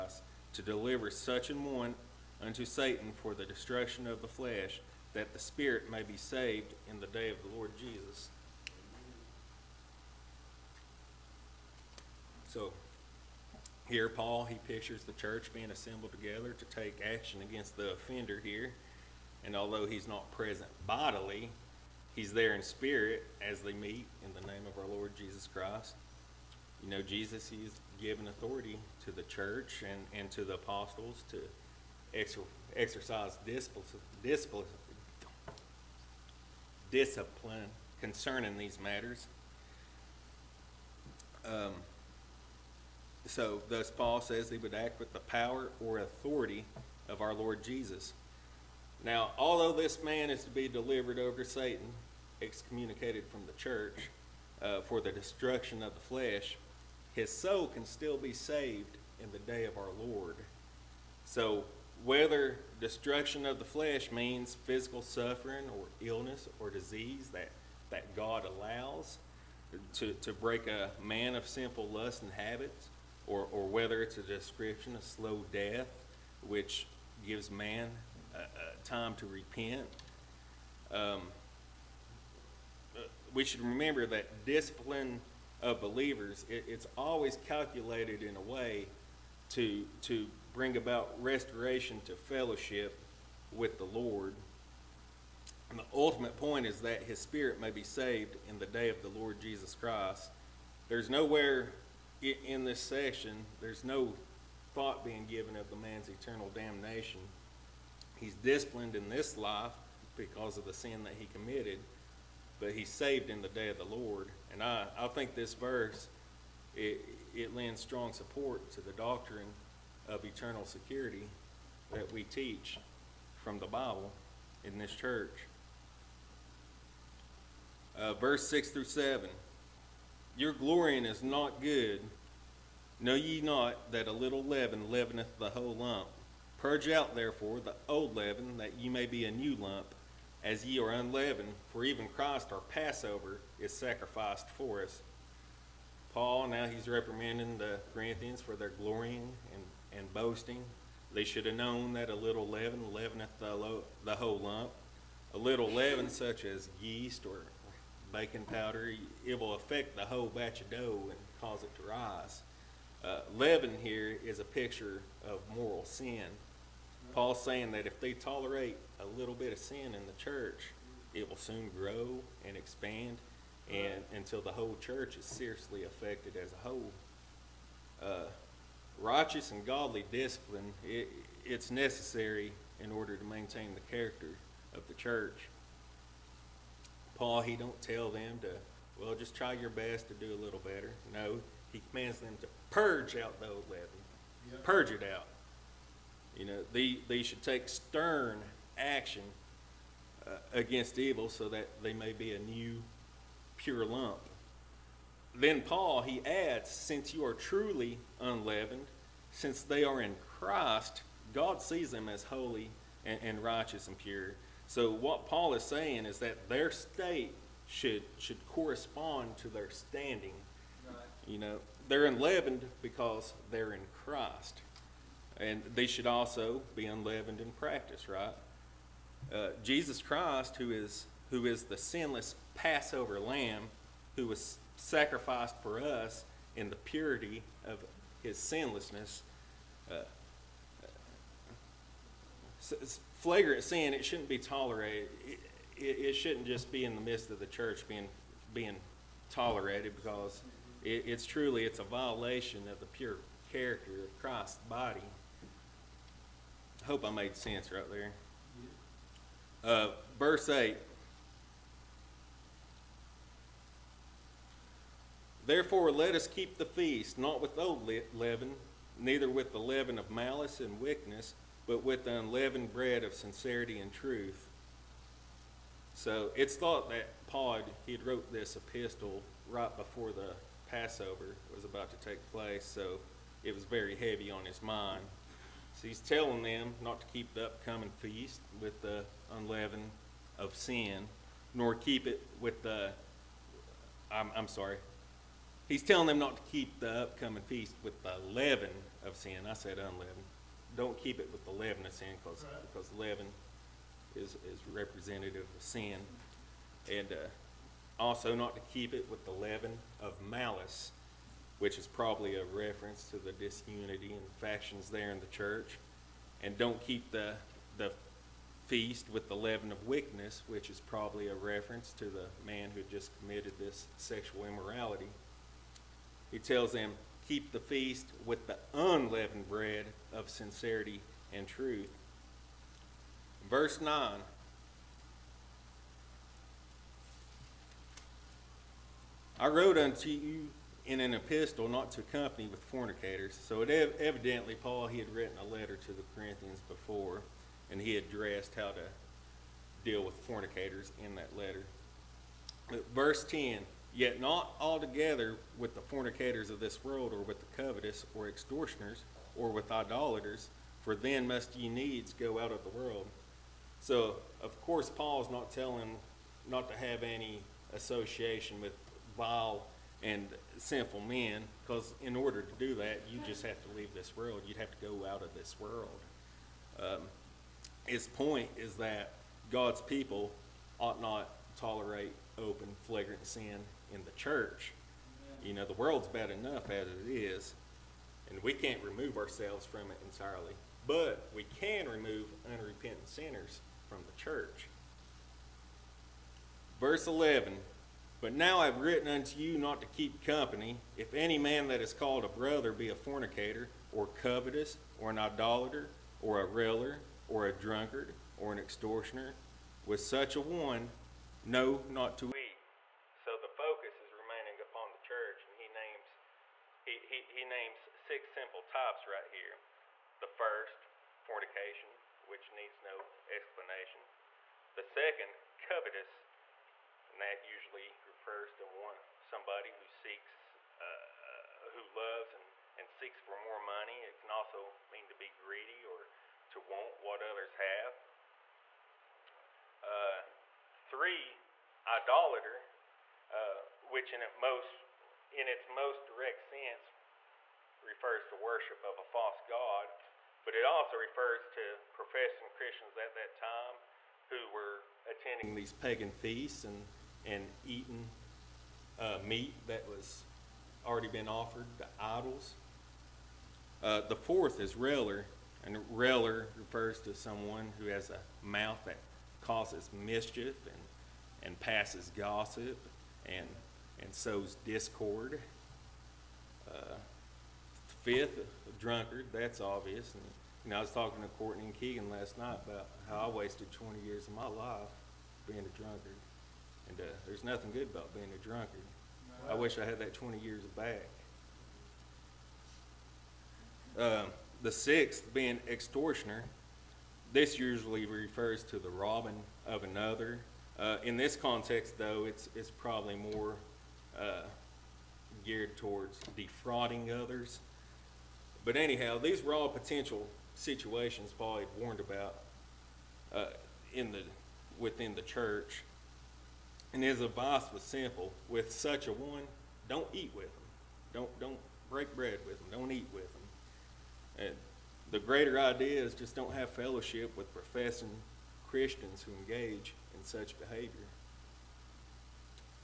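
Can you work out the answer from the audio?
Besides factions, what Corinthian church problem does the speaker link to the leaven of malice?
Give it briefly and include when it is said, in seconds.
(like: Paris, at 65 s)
disunity, at 313 s.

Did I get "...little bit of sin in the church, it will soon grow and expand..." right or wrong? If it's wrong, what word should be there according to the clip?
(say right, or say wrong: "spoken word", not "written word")
right.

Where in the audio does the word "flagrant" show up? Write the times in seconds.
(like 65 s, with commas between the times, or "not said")
243 s, 382 s.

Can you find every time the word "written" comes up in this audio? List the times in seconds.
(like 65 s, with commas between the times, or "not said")
345 s, 398 s.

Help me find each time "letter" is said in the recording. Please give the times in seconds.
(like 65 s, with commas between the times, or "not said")
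345 s, 351 s.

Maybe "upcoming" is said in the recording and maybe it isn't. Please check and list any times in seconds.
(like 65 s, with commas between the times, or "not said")
287 s, 296 s.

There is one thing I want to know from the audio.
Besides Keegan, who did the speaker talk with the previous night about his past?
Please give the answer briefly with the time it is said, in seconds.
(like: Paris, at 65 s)
Courtney, at 481 s.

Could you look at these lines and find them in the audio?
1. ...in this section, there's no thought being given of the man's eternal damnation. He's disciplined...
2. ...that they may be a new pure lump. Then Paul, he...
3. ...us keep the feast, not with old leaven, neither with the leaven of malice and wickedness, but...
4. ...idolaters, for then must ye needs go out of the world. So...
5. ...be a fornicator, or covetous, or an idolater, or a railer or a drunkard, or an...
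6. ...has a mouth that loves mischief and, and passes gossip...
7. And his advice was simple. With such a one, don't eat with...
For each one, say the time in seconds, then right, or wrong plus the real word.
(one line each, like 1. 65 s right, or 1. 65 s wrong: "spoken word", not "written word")
1. 102 s right
2. 201 s right
3. 266 s right
4. 359 s right
5. 402 s right
6. 467 s wrong: "causes", not "loves"
7. 516 s right.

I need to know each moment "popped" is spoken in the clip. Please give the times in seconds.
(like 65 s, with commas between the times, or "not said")
not said.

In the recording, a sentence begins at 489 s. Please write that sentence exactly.
I wish I had that 20 years back.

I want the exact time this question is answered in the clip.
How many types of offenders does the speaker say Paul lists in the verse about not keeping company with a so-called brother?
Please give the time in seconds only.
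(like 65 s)
417 s.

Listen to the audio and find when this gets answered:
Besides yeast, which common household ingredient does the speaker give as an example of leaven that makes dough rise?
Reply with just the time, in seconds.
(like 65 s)
158 s.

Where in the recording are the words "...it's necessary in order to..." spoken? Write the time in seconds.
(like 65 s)
181 s.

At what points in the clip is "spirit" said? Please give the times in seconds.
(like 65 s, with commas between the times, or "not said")
5 s, 22 s, 97 s.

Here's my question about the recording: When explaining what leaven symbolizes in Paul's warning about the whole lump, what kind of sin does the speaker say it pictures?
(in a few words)
moral sin.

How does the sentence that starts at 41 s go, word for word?
Um, so, thus, Paul says he would act with the power or authority of our Lord Jesus.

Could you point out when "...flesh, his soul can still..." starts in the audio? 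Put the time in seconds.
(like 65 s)
56 s.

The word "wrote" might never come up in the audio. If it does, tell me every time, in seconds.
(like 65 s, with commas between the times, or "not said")
277 s, 339 s.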